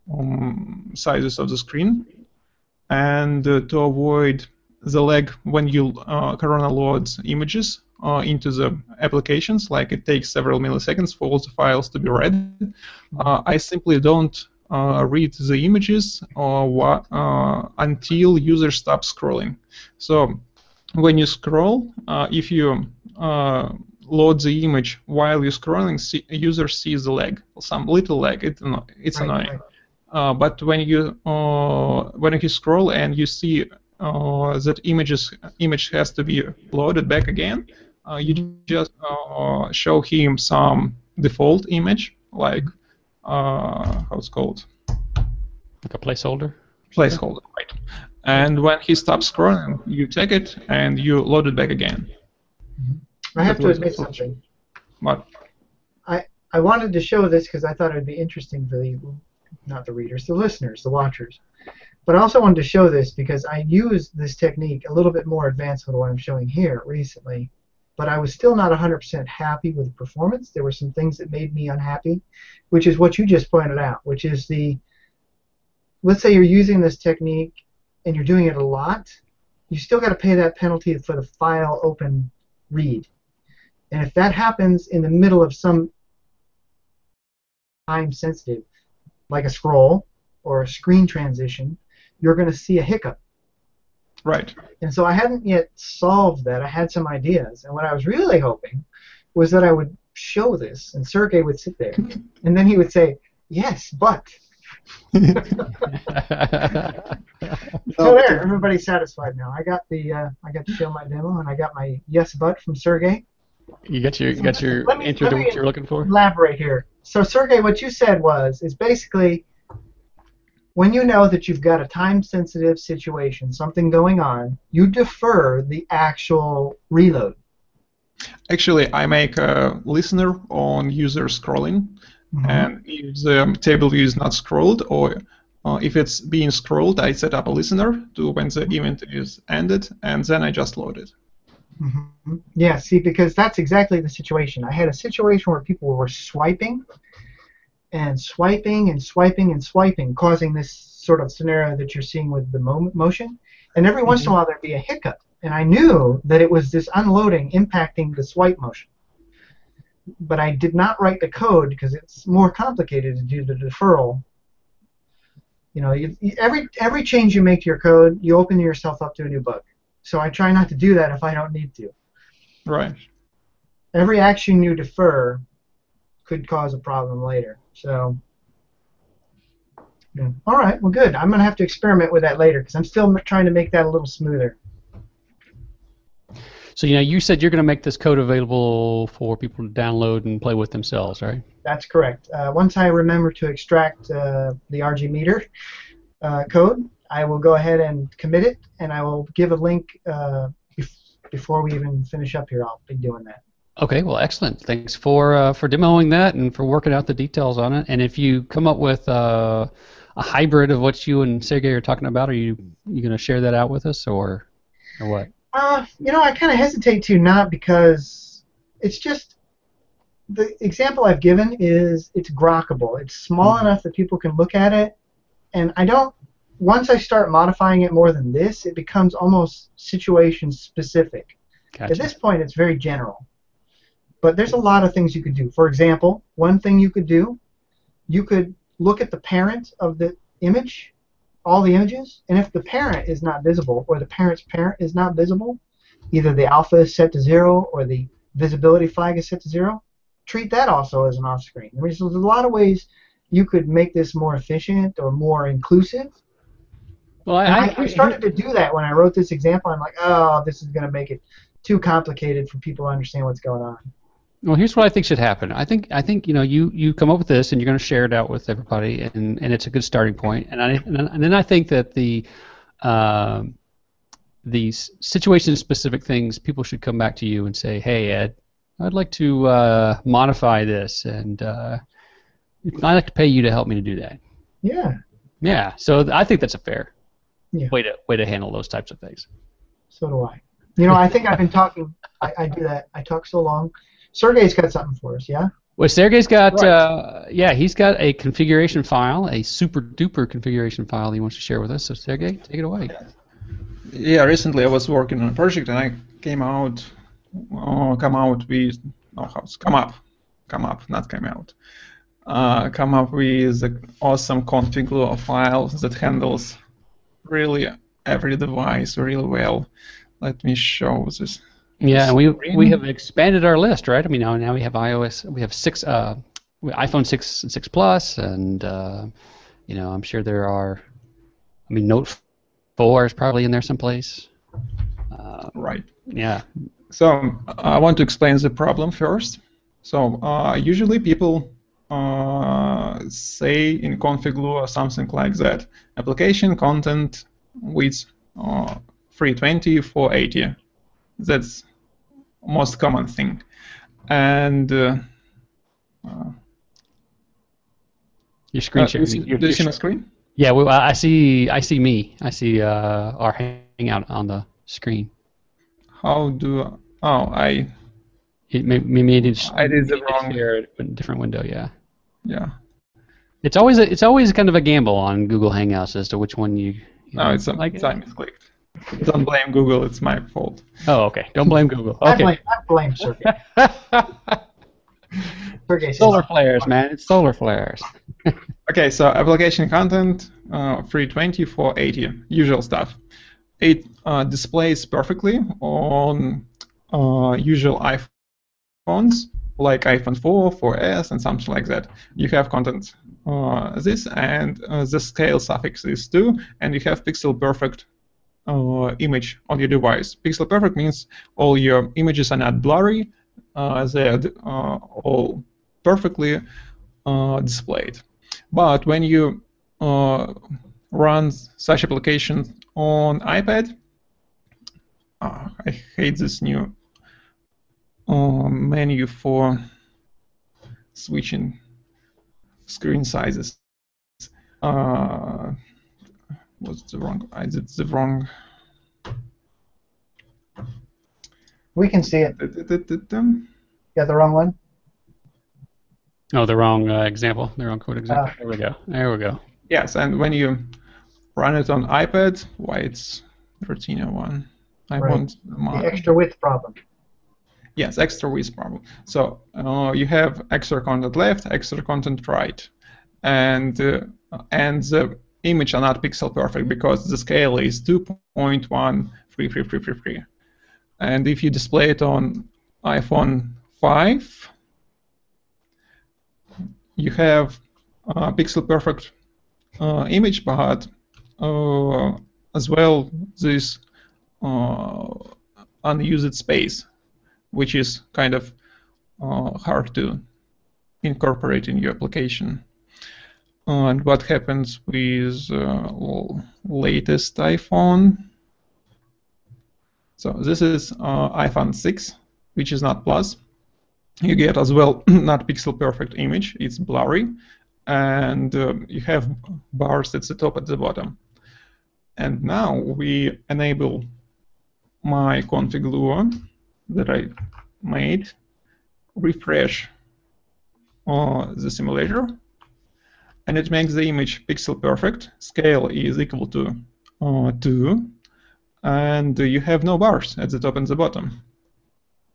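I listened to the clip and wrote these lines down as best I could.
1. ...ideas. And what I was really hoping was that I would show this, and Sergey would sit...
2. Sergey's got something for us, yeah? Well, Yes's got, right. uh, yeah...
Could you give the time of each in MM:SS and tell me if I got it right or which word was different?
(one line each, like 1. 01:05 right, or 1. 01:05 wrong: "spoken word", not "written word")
1. 01:37 right
2. 04:54 wrong: "Sergey", not "Yes".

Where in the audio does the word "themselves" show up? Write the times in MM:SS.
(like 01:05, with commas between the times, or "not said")
03:10.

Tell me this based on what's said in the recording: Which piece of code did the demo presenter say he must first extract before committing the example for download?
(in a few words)
RG meter.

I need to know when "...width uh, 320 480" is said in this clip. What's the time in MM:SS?
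05:47.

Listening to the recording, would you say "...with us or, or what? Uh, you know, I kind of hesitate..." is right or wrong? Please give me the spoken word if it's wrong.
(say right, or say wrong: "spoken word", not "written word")
right.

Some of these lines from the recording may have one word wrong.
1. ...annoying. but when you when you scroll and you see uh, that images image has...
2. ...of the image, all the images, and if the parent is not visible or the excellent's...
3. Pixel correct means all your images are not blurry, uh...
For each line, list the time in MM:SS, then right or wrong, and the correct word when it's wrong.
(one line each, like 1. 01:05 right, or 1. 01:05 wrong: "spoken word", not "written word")
1. 00:29 right
2. 03:59 wrong: "parent", not "excellent"
3. 06:50 wrong: "perfect", not "correct".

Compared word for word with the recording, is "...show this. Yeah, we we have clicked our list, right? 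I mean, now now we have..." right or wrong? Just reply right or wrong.
wrong.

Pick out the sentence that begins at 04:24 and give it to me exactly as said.
Well, here's what I think should happen.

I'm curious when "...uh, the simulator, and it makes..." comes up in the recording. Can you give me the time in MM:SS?
08:41.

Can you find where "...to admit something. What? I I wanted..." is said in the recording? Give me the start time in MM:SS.
00:53.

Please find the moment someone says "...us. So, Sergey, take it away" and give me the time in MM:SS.
05:01.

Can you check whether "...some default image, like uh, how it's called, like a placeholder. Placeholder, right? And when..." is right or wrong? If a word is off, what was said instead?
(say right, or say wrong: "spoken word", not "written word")
right.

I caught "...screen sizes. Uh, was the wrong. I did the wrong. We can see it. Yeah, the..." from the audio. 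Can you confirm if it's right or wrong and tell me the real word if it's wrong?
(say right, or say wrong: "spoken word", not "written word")
right.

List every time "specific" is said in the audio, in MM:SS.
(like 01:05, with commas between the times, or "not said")
03:50, 04:35.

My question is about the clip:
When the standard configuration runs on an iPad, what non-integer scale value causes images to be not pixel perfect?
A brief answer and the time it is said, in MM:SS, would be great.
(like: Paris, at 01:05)
2.133333, at 07:47.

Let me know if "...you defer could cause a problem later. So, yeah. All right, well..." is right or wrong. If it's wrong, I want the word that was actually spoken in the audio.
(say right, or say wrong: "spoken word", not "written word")
right.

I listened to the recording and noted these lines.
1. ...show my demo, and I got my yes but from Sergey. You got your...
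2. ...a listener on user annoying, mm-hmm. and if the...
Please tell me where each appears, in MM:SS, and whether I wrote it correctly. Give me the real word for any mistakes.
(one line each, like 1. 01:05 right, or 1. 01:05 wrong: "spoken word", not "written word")
1. 01:50 right
2. 02:09 wrong: "scrolling", not "annoying".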